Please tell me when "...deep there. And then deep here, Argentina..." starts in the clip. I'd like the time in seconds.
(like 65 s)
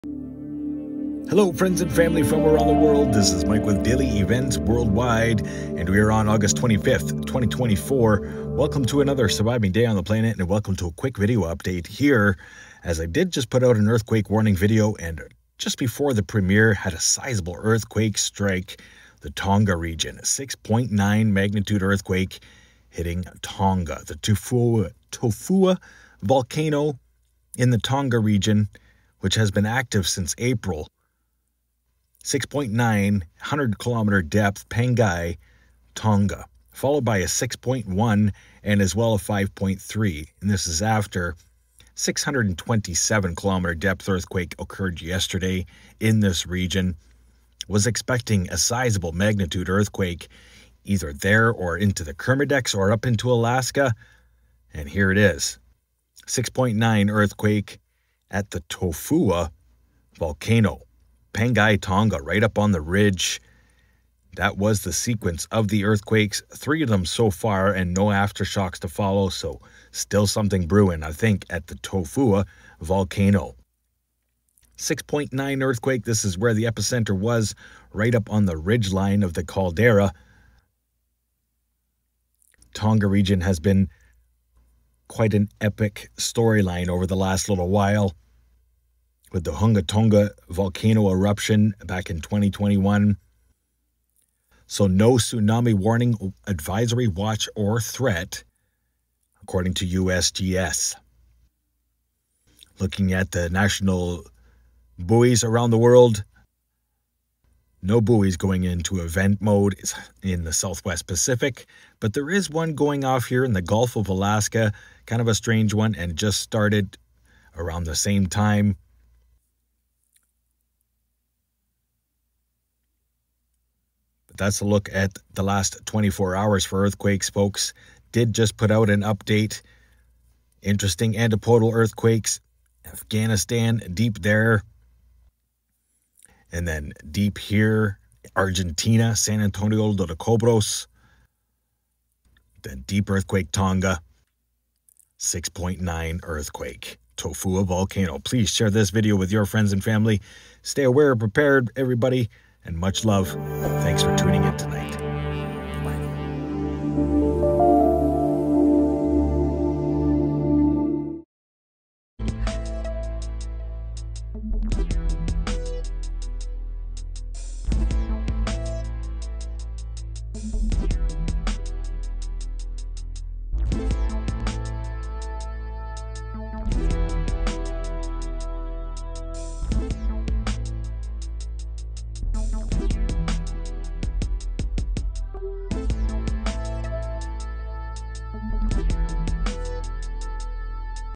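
133 s.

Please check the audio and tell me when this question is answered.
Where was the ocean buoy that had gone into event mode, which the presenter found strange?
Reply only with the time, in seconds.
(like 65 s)
113 s.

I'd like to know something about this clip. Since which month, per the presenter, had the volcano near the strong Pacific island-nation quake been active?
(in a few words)
April.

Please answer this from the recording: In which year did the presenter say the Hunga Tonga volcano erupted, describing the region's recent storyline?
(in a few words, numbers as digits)
2021.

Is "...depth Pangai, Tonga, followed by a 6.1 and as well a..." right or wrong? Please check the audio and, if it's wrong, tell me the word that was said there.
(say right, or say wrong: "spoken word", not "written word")
right.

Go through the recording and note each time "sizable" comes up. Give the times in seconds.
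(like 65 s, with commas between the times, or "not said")
16 s, 48 s.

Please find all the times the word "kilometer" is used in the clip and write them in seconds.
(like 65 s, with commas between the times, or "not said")
33 s, 43 s.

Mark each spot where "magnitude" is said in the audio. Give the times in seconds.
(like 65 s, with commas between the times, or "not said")
21 s, 49 s.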